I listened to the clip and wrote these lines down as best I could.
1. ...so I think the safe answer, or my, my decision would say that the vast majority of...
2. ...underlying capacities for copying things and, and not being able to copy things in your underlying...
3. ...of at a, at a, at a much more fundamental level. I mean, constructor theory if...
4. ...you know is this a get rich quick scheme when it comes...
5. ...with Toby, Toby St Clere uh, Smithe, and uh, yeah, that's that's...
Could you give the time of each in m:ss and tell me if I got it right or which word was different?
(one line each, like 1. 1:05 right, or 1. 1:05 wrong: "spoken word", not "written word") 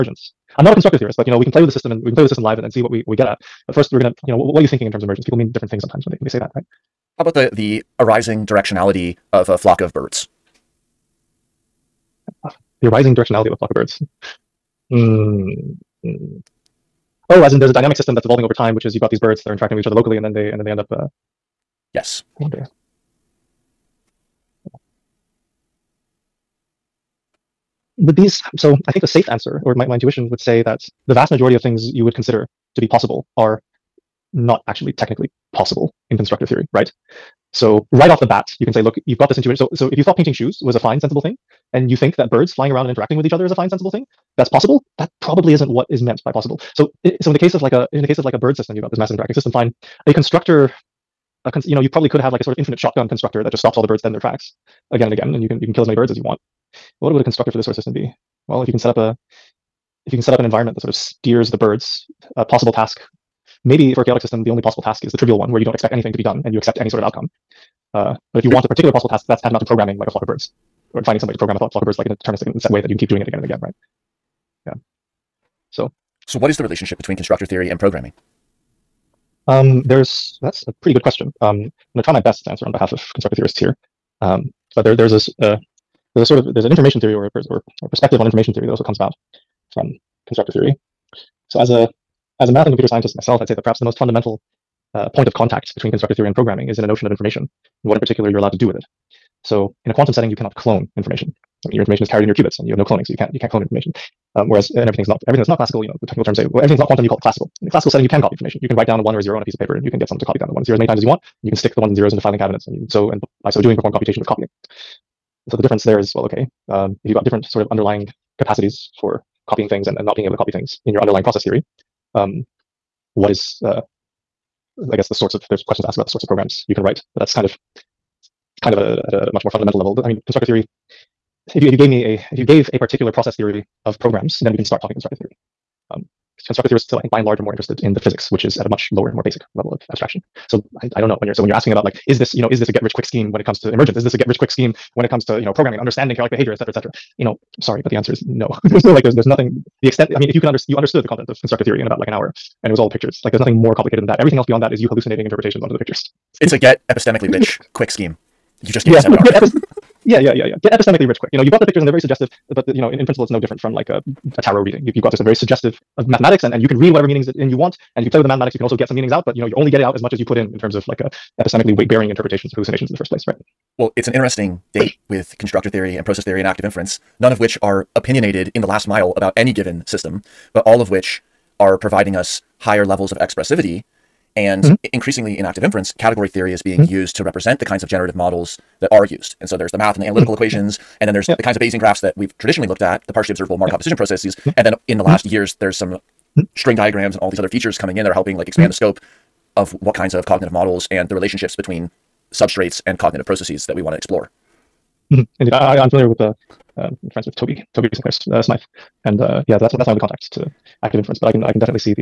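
1. 0:28 wrong: "intuition", not "decision"
2. 1:57 right
3. 2:08 right
4. 2:22 right
5. 3:27 right.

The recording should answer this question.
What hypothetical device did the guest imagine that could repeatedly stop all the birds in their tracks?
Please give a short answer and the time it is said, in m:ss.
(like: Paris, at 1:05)
Infinite shotgun constructor, at 0:52.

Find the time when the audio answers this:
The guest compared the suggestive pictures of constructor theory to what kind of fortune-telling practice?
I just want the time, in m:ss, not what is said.
2:44.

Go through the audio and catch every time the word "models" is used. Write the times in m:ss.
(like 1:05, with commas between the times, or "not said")
3:08, 3:20.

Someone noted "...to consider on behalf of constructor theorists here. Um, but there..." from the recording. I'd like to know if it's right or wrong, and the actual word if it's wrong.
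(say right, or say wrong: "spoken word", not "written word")
wrong: "answer", not "consider".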